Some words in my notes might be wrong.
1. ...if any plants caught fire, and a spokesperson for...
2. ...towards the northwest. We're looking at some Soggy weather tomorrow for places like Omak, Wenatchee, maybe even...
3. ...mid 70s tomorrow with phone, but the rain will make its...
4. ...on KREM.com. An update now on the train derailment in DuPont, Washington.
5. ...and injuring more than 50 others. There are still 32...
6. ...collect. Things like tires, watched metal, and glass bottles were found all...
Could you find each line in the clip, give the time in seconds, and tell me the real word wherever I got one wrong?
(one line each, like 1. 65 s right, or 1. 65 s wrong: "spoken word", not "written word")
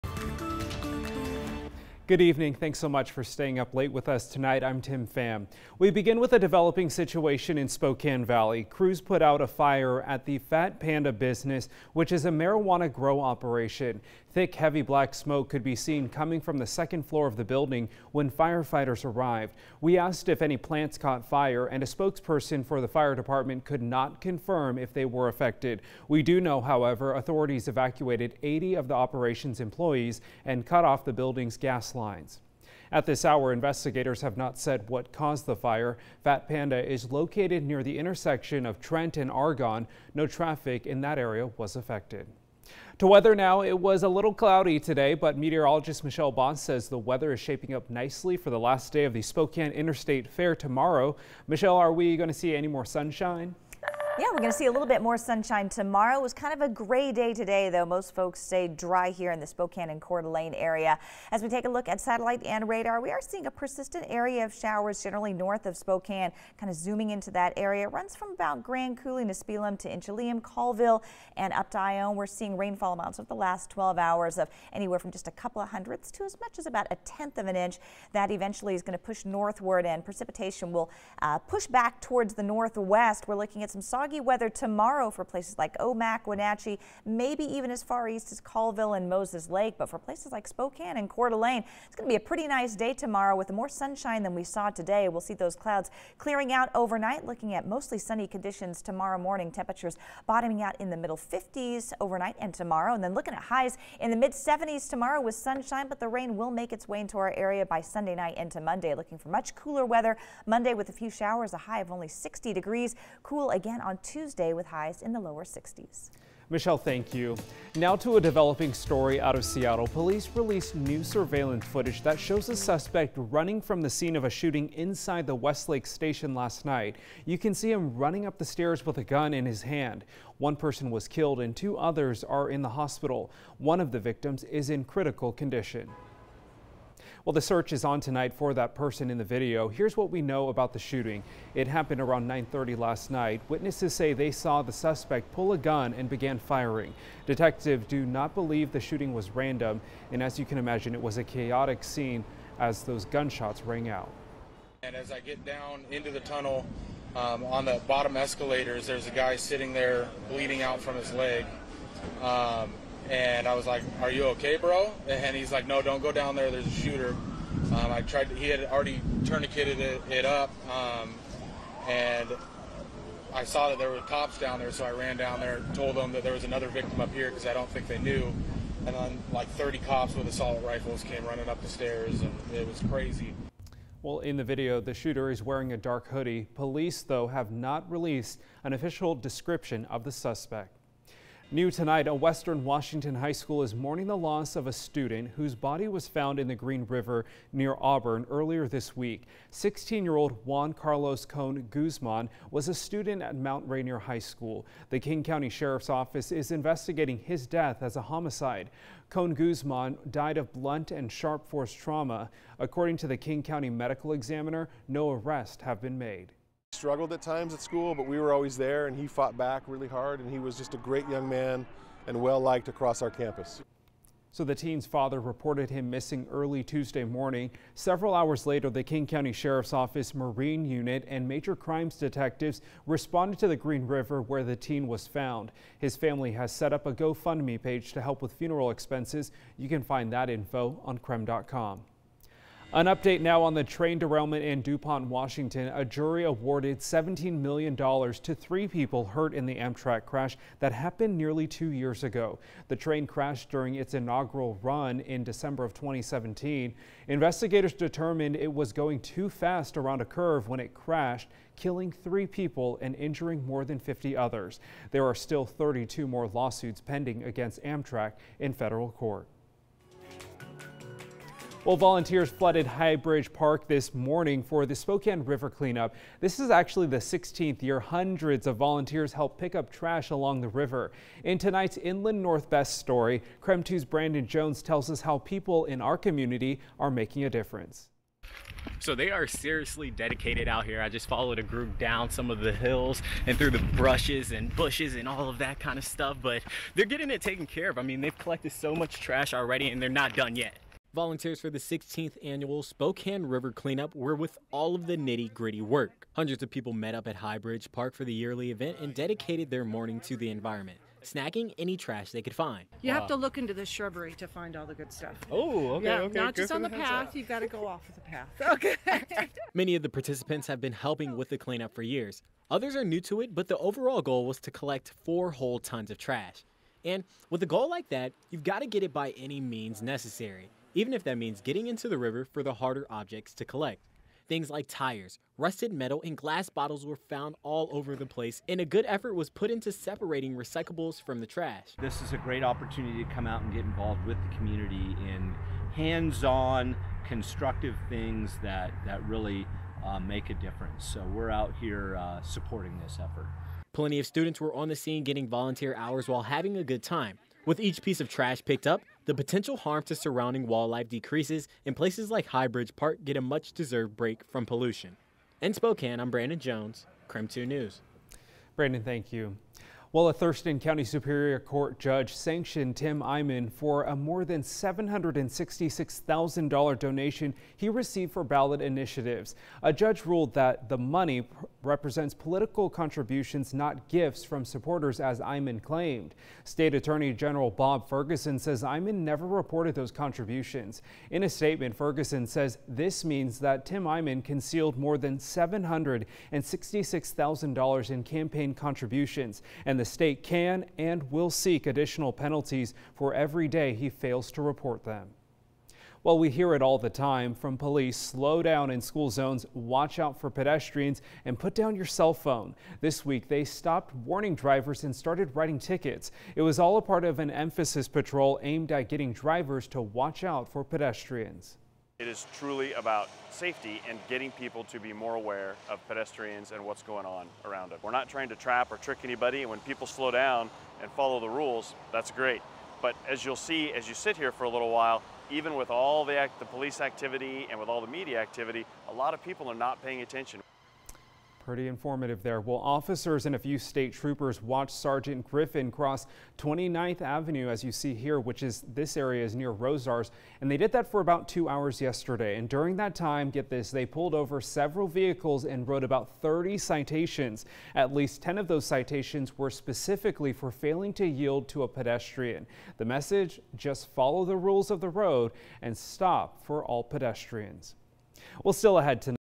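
1. 20 s right
2. 82 s right
3. 104 s wrong: "sunshine", not "phone"
4. 240 s right
5. 262 s right
6. 333 s wrong: "rusted", not "watched".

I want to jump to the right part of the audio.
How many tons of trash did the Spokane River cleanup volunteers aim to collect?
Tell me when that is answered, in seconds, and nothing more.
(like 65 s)
325 s.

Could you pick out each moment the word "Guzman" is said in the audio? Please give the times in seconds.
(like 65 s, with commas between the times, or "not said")
201 s, 209 s.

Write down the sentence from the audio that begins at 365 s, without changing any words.
In Spokane, I'm Brandon Jones, KREM 2 News.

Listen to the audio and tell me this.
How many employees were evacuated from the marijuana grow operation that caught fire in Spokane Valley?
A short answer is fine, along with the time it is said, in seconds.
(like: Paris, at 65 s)
80, at 28 s.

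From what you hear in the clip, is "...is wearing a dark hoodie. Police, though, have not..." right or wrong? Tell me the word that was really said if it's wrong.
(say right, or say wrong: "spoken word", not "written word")
right.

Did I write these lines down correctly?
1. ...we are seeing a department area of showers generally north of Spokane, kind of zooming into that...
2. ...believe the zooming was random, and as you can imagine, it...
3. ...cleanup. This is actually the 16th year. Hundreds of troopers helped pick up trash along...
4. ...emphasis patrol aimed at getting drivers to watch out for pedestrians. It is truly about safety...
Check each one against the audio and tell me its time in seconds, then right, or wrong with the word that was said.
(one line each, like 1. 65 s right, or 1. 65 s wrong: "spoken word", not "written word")
1. 62 s wrong: "persistent", not "department"
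2. 148 s wrong: "shooting", not "zooming"
3. 275 s wrong: "volunteers", not "troopers"
4. 417 s right.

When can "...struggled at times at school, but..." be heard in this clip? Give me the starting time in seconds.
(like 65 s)
216 s.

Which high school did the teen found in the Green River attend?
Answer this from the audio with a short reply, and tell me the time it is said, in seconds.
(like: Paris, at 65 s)
Mount Rainier High School, at 203 s.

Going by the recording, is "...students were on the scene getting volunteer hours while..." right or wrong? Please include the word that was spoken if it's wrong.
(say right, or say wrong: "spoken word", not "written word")
right.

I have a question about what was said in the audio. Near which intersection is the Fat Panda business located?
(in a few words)
Trent and Argonne.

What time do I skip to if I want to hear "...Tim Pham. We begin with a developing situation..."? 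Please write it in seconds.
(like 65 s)
4 s.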